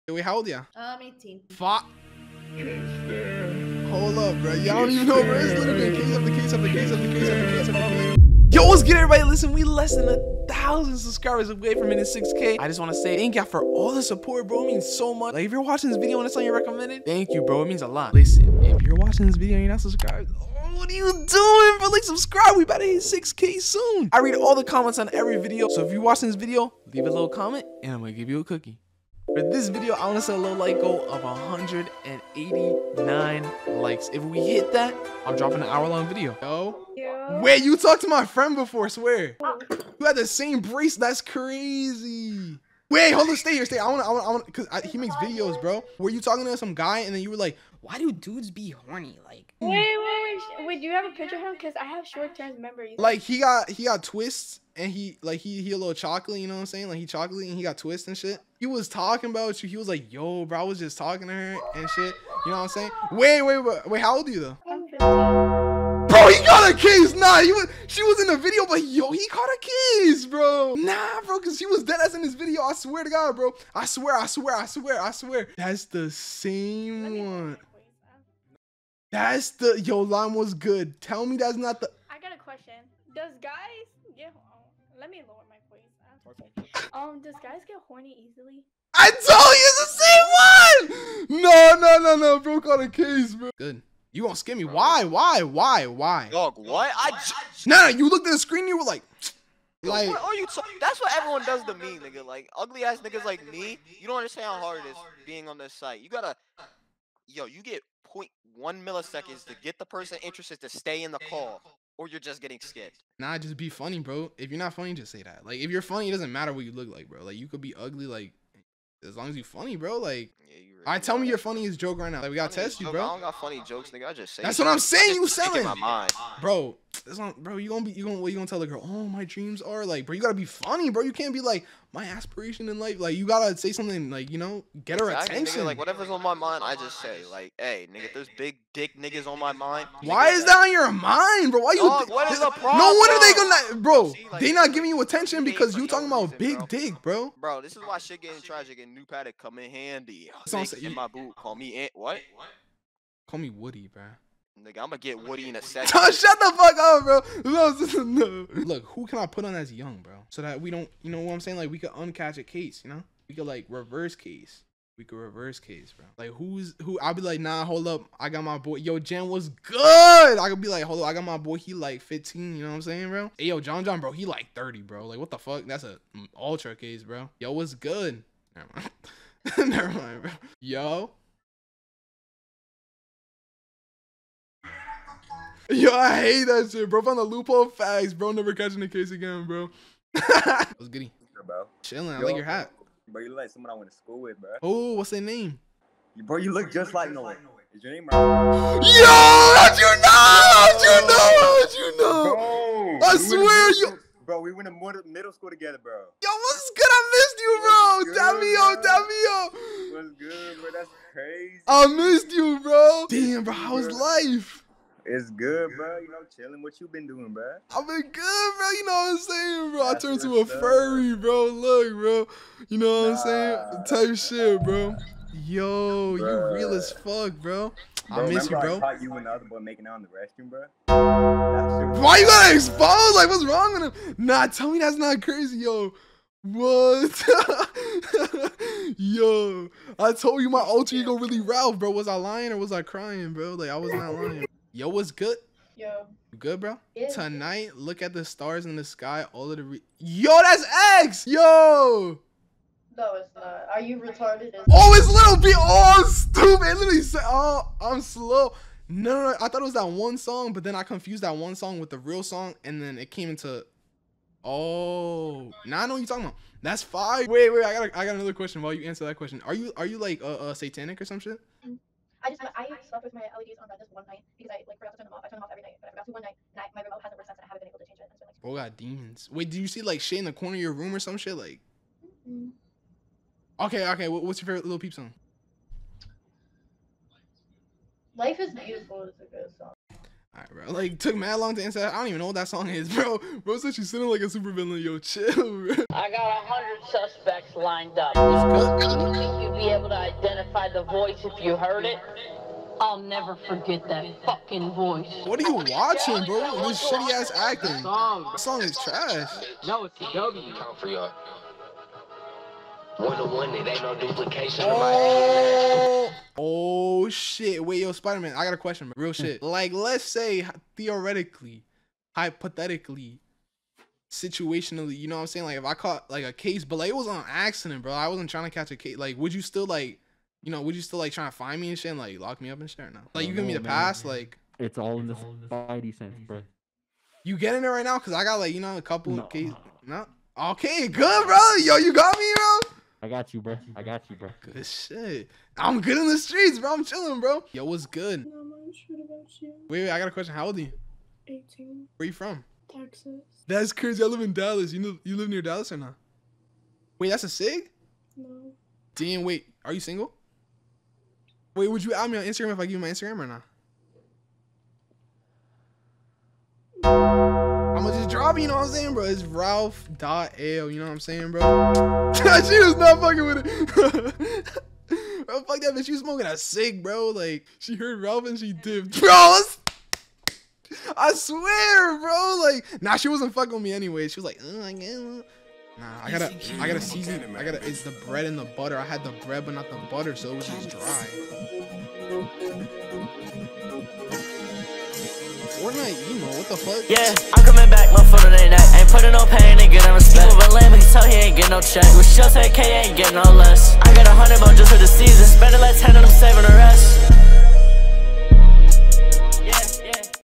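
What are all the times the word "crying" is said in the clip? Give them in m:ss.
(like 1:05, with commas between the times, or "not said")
4:02.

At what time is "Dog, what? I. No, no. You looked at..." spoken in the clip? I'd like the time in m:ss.
1:36.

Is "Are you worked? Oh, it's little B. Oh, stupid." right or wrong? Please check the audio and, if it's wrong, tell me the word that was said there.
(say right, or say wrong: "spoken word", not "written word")
wrong: "retarded", not "worked".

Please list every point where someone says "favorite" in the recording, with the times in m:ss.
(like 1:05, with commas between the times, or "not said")
4:44.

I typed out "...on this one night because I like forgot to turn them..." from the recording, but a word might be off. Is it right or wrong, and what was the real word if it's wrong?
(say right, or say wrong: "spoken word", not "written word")
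right.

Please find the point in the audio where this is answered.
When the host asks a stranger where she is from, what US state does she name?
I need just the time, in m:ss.
5:52.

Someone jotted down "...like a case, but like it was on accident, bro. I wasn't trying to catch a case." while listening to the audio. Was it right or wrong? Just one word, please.
right.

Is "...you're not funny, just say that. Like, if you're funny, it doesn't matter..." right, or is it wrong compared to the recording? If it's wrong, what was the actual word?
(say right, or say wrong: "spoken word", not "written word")
right.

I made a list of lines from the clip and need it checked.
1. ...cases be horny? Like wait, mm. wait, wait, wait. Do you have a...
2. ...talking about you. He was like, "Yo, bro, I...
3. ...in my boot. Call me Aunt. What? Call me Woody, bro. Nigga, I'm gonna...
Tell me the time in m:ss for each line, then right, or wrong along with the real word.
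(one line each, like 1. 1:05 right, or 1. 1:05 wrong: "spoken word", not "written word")
1. 0:48 wrong: "dudes", not "cases"
2. 0:58 right
3. 2:30 right.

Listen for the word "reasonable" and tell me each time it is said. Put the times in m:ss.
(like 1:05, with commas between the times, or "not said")
not said.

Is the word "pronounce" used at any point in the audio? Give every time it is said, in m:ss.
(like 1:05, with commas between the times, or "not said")
not said.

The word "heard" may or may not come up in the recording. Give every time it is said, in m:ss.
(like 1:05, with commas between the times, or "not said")
5:01, 6:17.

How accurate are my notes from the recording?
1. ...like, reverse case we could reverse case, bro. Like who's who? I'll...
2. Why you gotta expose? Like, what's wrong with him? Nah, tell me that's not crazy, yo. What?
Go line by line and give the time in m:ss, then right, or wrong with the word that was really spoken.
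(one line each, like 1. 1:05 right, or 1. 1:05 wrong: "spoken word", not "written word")
1. 2:43 right
2. 3:52 right.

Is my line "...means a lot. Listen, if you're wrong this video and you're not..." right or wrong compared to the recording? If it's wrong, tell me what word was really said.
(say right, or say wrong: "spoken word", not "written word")
wrong: "watching", not "wrong".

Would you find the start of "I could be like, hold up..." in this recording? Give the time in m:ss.
2:50.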